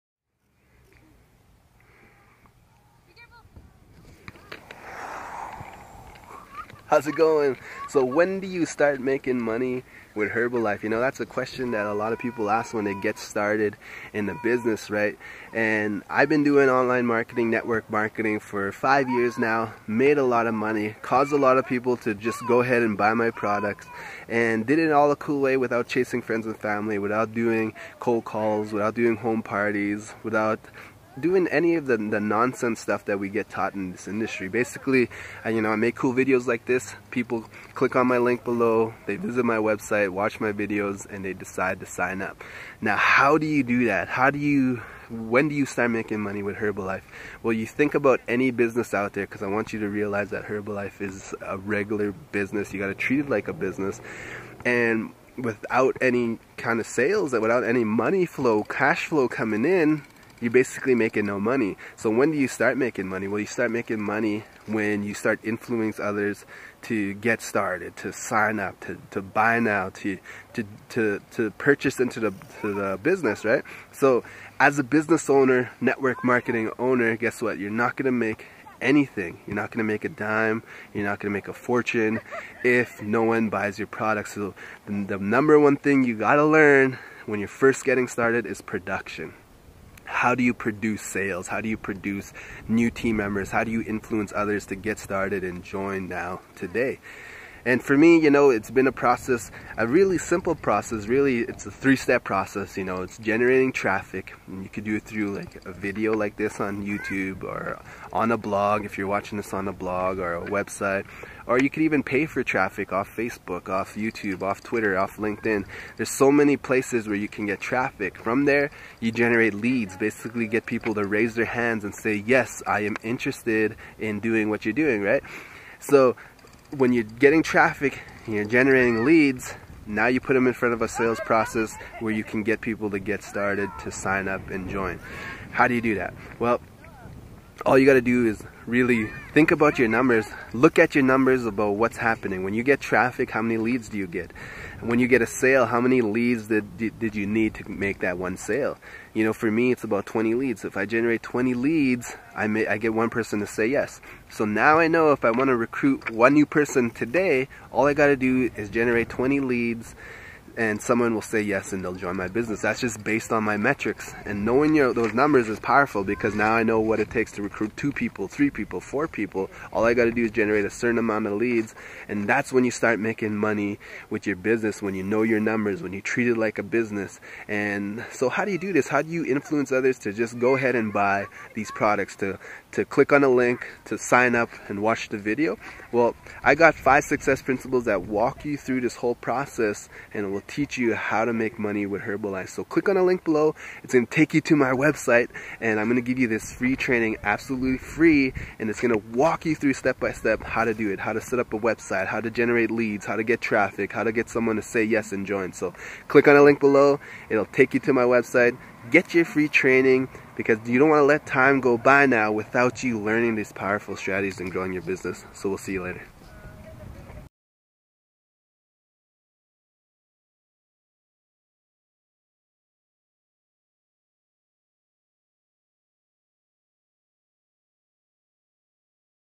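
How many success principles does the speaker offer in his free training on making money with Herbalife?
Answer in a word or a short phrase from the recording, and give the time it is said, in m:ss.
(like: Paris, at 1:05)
5, at 3:06.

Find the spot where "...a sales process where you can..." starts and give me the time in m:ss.
2:10.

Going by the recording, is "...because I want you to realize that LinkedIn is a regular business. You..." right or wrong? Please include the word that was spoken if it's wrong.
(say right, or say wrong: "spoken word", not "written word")
wrong: "Herbalife", not "LinkedIn".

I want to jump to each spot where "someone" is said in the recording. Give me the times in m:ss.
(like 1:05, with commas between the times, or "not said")
2:40, 3:24.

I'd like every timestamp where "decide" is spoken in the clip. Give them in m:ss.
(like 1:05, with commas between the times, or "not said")
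0:41.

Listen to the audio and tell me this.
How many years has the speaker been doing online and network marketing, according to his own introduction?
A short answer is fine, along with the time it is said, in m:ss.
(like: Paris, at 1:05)
5, at 0:18.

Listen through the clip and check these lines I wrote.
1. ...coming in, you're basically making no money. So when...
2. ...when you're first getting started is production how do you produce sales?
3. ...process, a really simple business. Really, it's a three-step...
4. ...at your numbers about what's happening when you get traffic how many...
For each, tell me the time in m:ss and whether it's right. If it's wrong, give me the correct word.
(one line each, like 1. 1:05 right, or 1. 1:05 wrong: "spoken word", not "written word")
1. 0:59 right
2. 1:27 right
3. 1:38 wrong: "process", not "business"
4. 2:20 right.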